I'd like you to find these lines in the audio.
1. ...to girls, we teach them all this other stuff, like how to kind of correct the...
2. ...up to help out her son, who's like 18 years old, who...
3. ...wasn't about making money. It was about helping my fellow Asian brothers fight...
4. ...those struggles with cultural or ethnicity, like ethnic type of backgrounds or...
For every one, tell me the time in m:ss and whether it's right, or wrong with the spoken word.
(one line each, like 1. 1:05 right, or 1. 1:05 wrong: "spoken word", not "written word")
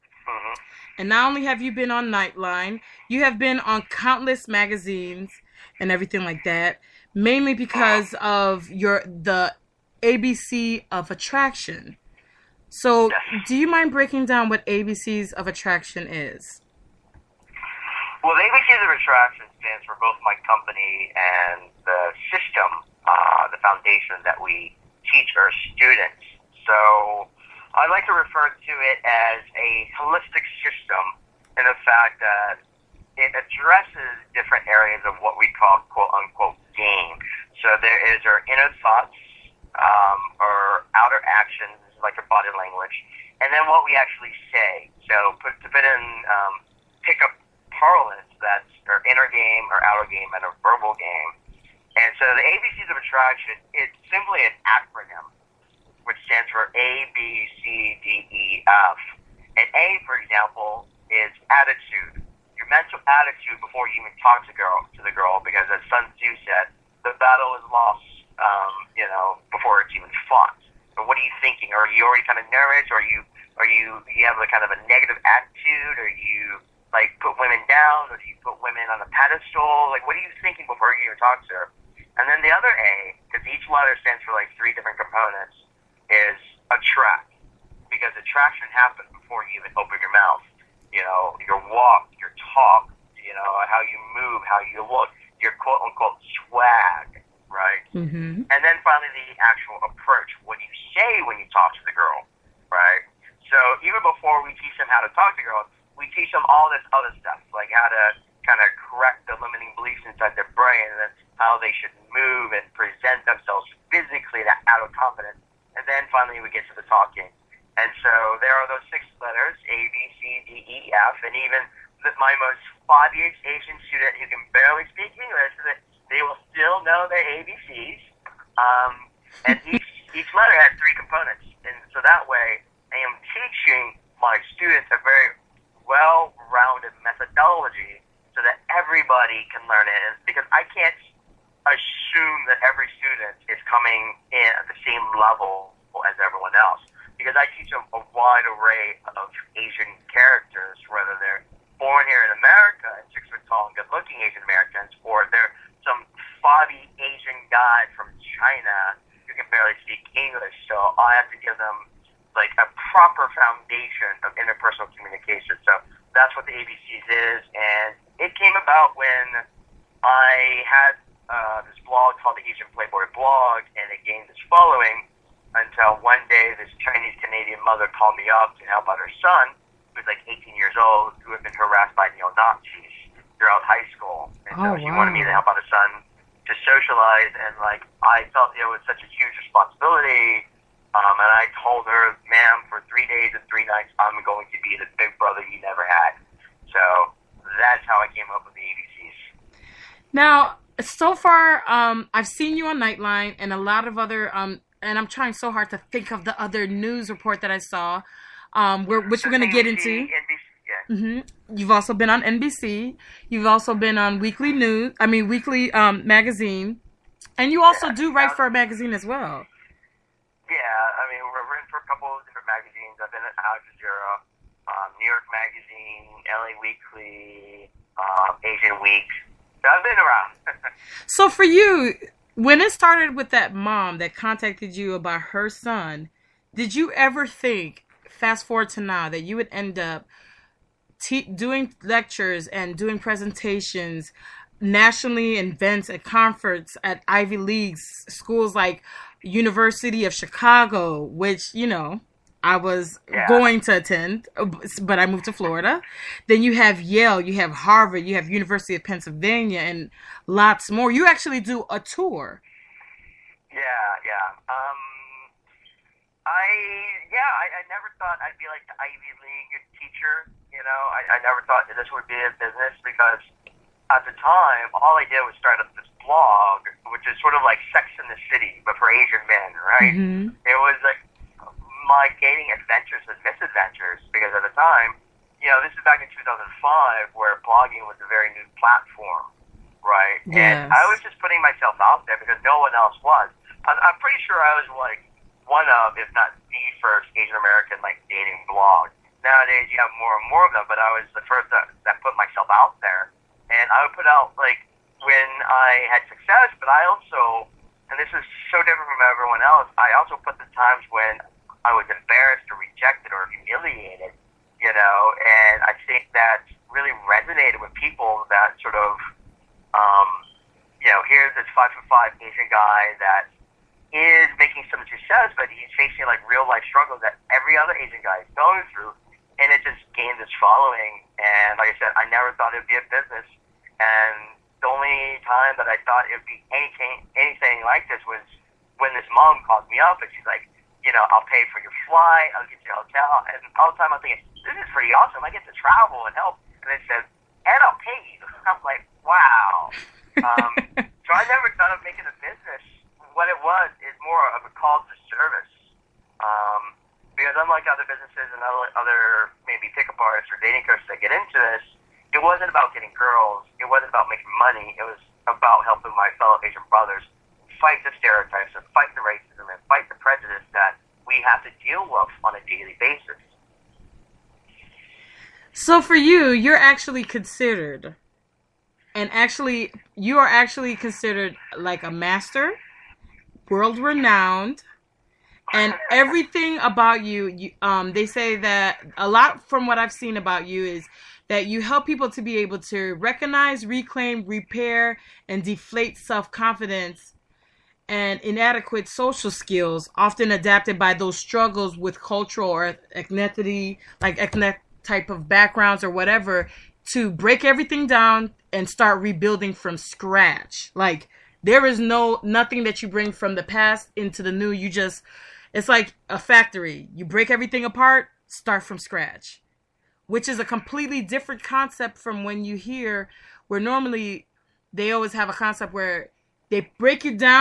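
1. 1:45 right
2. 2:58 right
3. 6:03 right
4. 6:40 right.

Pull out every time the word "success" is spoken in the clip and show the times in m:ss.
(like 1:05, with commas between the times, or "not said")
5:06, 5:24.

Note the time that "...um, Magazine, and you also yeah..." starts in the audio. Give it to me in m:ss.
3:35.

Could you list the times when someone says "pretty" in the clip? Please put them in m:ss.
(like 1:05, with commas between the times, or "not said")
4:54, 5:44.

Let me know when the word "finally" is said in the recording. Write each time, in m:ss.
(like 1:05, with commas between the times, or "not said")
1:38, 1:56.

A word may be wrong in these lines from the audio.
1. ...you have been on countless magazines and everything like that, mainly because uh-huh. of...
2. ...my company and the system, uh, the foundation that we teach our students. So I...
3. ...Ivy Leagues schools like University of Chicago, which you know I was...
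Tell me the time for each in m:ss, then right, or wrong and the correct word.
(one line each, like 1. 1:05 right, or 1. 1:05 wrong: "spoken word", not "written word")
1. 0:03 right
2. 0:20 right
3. 4:07 right.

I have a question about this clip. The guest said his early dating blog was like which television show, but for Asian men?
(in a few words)
Sex in the City.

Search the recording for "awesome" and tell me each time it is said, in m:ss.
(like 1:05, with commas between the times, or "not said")
5:44.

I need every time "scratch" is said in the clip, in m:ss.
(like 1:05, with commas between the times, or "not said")
6:49, 6:58.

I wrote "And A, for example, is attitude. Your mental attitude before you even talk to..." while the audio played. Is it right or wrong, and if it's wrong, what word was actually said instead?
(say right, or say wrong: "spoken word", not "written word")
right.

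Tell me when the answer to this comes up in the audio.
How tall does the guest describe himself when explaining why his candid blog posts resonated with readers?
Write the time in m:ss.
5:21.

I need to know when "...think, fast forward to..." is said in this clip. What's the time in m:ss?
3:57.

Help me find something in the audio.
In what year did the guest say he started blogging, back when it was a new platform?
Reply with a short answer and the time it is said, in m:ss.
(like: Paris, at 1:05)
2005, at 4:46.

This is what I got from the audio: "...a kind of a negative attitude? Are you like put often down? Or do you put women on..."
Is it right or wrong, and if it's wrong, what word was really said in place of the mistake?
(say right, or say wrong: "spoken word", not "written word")
wrong: "women", not "often".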